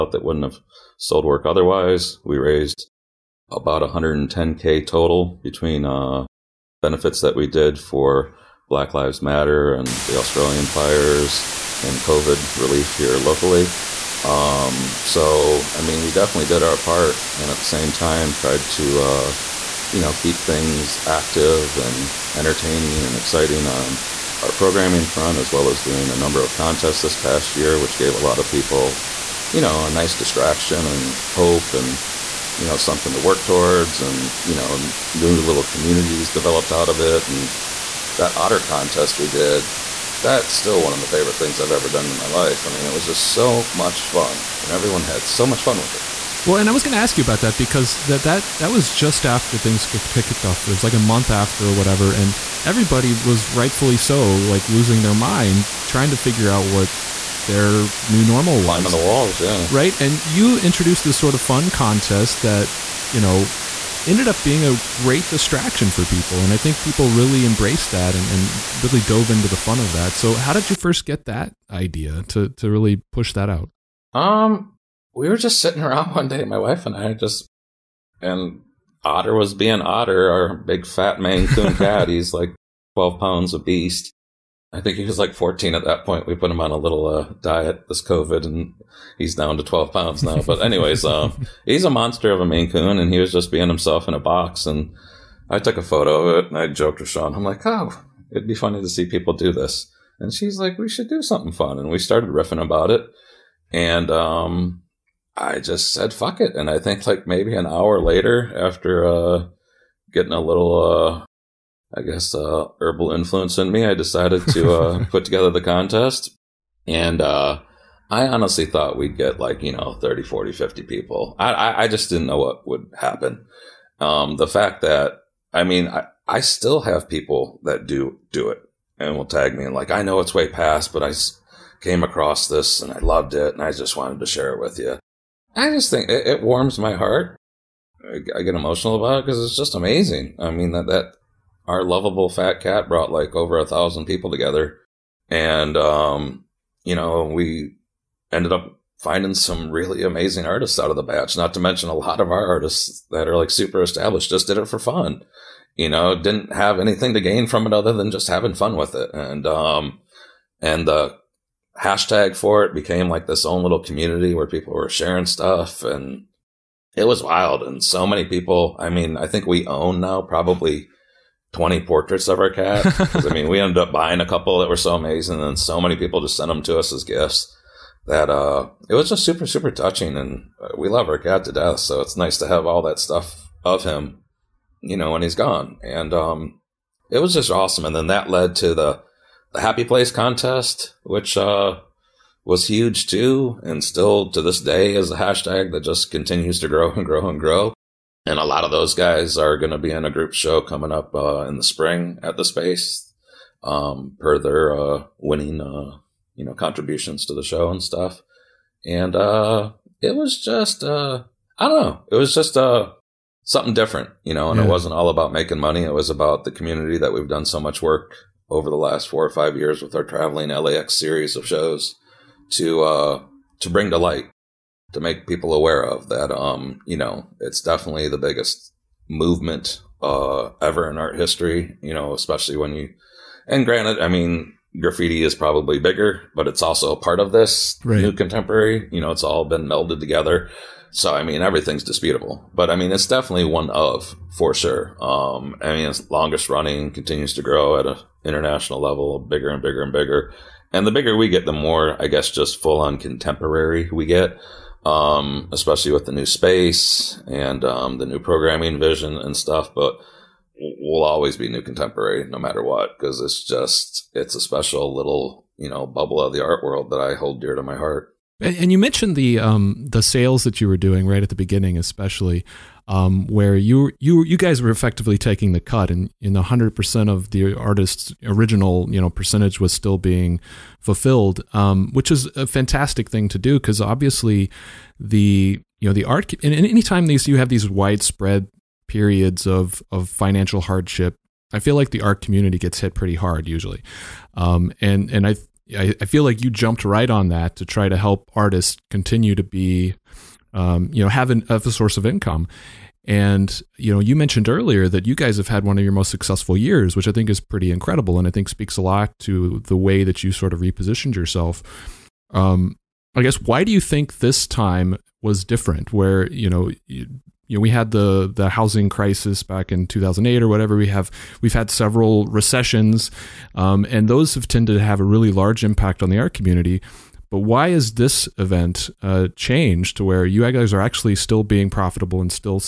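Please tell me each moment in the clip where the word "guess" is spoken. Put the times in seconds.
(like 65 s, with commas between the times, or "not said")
112 s, 252 s, 313 s.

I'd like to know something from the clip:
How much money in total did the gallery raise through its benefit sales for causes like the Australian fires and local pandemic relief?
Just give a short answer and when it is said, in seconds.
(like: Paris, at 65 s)
110k, at 3 s.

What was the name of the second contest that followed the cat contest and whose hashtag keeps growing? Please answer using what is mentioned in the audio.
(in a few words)
Happy Place.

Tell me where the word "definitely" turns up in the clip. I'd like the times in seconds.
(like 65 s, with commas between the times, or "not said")
16 s, 227 s, 243 s.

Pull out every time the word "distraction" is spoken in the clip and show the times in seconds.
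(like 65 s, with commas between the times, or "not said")
30 s, 65 s.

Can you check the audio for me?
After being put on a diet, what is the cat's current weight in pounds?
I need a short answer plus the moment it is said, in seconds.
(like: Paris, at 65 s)
12, at 89 s.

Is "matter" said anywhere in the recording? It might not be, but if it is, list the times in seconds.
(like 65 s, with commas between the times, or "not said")
9 s, 262 s.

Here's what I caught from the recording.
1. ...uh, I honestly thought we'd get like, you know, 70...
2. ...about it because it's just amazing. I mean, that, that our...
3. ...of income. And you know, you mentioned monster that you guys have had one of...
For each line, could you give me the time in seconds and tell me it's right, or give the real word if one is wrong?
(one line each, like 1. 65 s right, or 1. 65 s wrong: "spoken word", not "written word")
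1. 117 s wrong: "30", not "70"
2. 139 s right
3. 301 s wrong: "earlier", not "monster".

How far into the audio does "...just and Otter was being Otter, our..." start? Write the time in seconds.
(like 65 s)
77 s.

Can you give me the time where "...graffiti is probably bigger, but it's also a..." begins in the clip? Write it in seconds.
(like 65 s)
234 s.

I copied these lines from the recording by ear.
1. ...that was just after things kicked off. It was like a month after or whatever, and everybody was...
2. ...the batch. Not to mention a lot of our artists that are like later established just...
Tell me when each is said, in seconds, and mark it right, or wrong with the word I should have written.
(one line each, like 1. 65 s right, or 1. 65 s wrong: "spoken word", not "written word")
1. 48 s right
2. 150 s wrong: "super", not "later".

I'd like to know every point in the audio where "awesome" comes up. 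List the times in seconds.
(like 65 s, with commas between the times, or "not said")
187 s.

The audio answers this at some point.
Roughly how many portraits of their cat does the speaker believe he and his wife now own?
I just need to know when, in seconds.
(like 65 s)
171 s.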